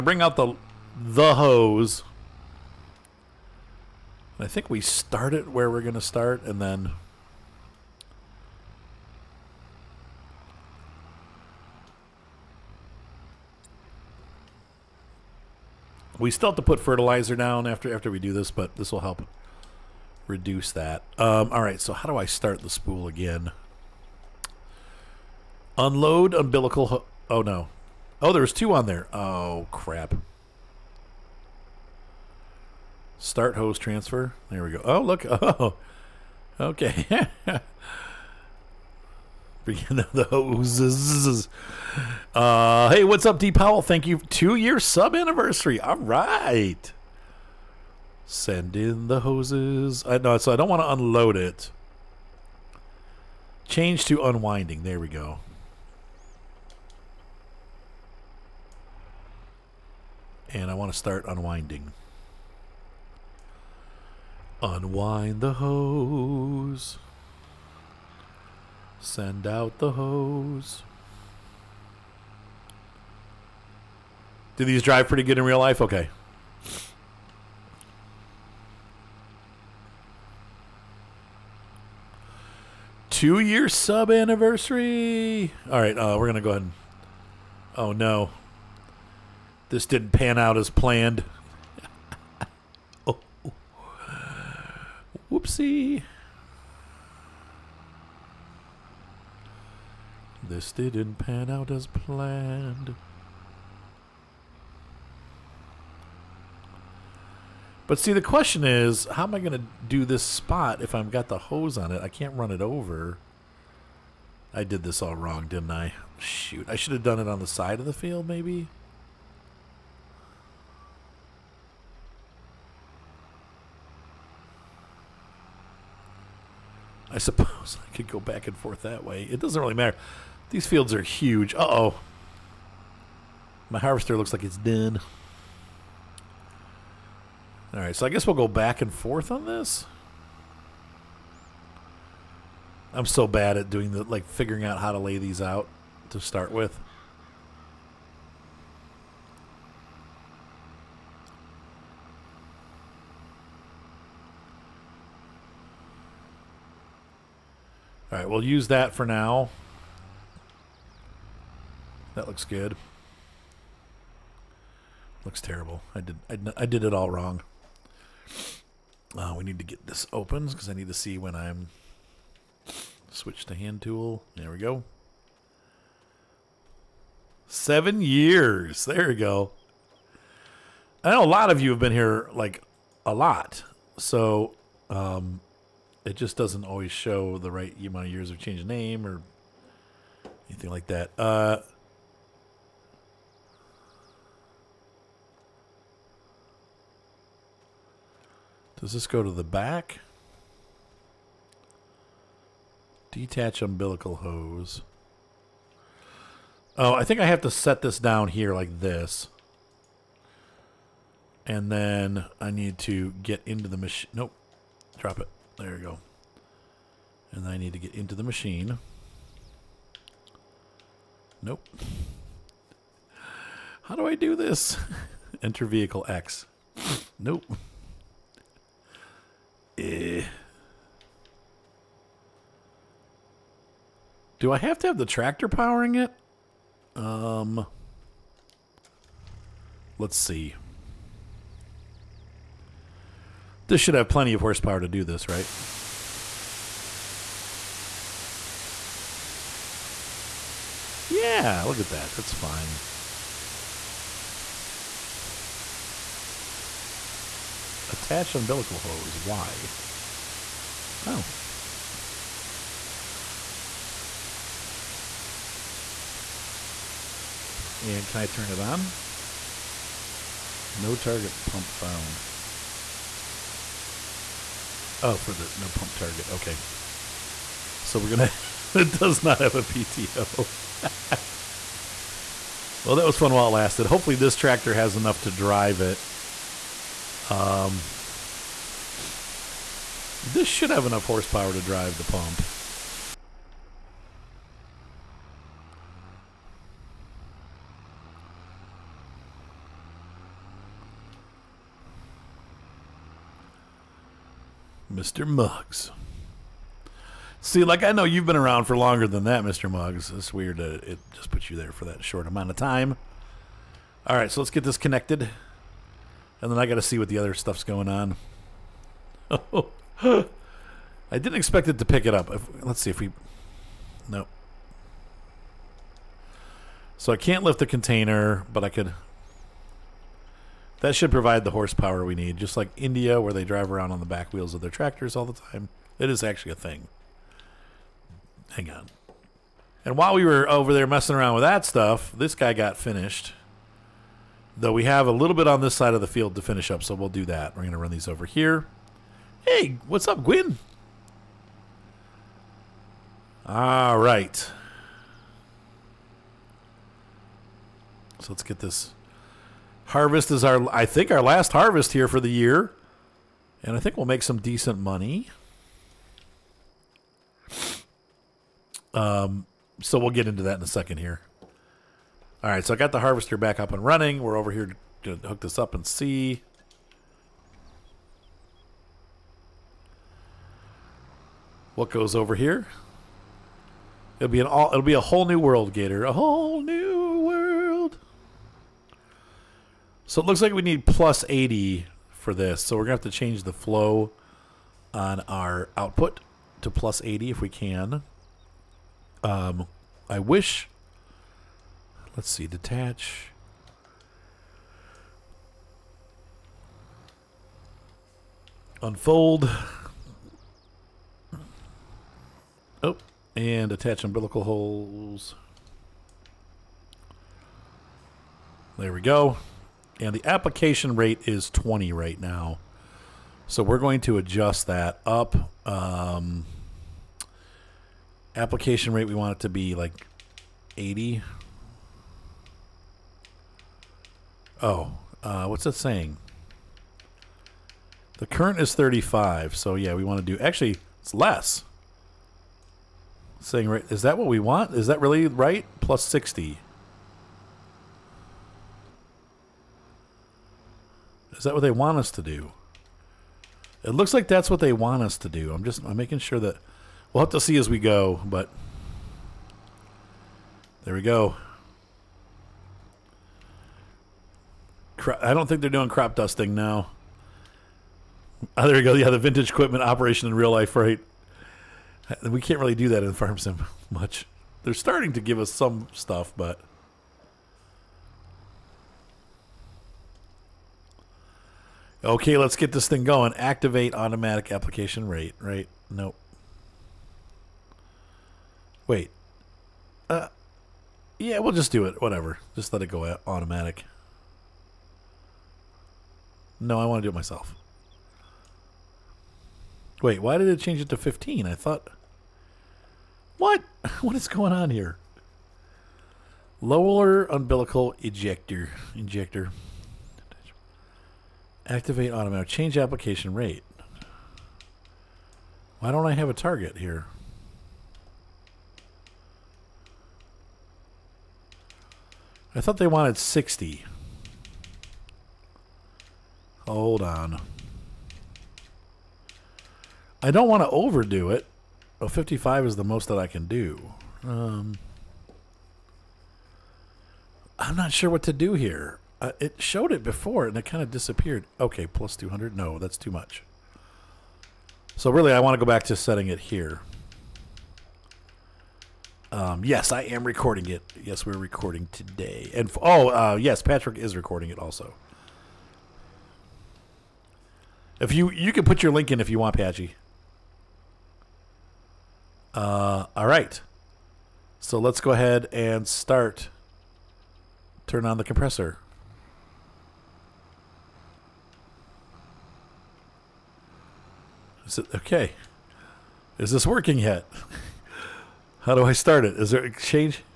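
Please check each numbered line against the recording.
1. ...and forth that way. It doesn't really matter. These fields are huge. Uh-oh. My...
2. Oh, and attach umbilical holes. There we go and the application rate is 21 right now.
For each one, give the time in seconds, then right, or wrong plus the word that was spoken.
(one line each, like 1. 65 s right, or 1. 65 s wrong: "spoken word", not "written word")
1. 128 s right
2. 412 s wrong: "20", not "21".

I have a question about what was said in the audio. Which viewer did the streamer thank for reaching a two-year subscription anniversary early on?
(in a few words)
D Powell.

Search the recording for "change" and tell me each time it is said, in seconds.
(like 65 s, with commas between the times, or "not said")
53 s, 188 s, 393 s, 500 s, 512 s, 579 s.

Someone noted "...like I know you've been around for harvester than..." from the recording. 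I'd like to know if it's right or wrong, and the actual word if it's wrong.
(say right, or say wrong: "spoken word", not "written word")
wrong: "longer", not "harvester".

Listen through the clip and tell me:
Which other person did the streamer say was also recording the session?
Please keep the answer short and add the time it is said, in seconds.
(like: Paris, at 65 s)
Patrick, at 553 s.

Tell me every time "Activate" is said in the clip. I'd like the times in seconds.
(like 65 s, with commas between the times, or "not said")
483 s, 511 s.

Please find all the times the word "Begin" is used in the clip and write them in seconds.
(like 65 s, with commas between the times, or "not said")
39 s.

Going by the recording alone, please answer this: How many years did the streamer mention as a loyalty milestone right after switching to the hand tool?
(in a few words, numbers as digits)
7.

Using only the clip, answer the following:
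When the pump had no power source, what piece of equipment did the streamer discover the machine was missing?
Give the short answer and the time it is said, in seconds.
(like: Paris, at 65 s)
PTO, at 279 s.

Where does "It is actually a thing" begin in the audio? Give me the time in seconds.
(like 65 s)
335 s.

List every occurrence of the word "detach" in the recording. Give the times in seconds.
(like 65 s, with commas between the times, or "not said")
203 s, 402 s.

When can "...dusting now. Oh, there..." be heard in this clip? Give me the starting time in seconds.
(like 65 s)
466 s.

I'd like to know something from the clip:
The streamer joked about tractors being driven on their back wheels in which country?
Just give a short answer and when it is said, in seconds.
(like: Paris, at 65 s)
India, at 332 s.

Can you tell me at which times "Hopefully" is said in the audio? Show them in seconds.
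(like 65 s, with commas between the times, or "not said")
283 s.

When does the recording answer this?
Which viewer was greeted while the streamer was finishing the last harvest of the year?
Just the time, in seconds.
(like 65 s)
350 s.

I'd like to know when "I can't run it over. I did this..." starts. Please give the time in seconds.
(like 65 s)
112 s.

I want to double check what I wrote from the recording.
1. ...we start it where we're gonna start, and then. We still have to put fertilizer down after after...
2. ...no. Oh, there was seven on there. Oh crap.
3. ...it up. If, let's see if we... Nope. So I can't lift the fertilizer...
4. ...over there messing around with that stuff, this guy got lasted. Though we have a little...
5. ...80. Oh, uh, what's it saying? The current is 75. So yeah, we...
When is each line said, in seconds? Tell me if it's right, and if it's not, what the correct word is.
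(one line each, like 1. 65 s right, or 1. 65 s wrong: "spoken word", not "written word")
1. 4 s right
2. 27 s wrong: "two", not "seven"
3. 322 s wrong: "container", not "fertilizer"
4. 340 s wrong: "finished", not "lasted"
5. 430 s wrong: "35", not "75".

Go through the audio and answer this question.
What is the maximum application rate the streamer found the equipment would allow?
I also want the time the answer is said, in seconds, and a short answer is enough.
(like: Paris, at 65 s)
55, at 532 s.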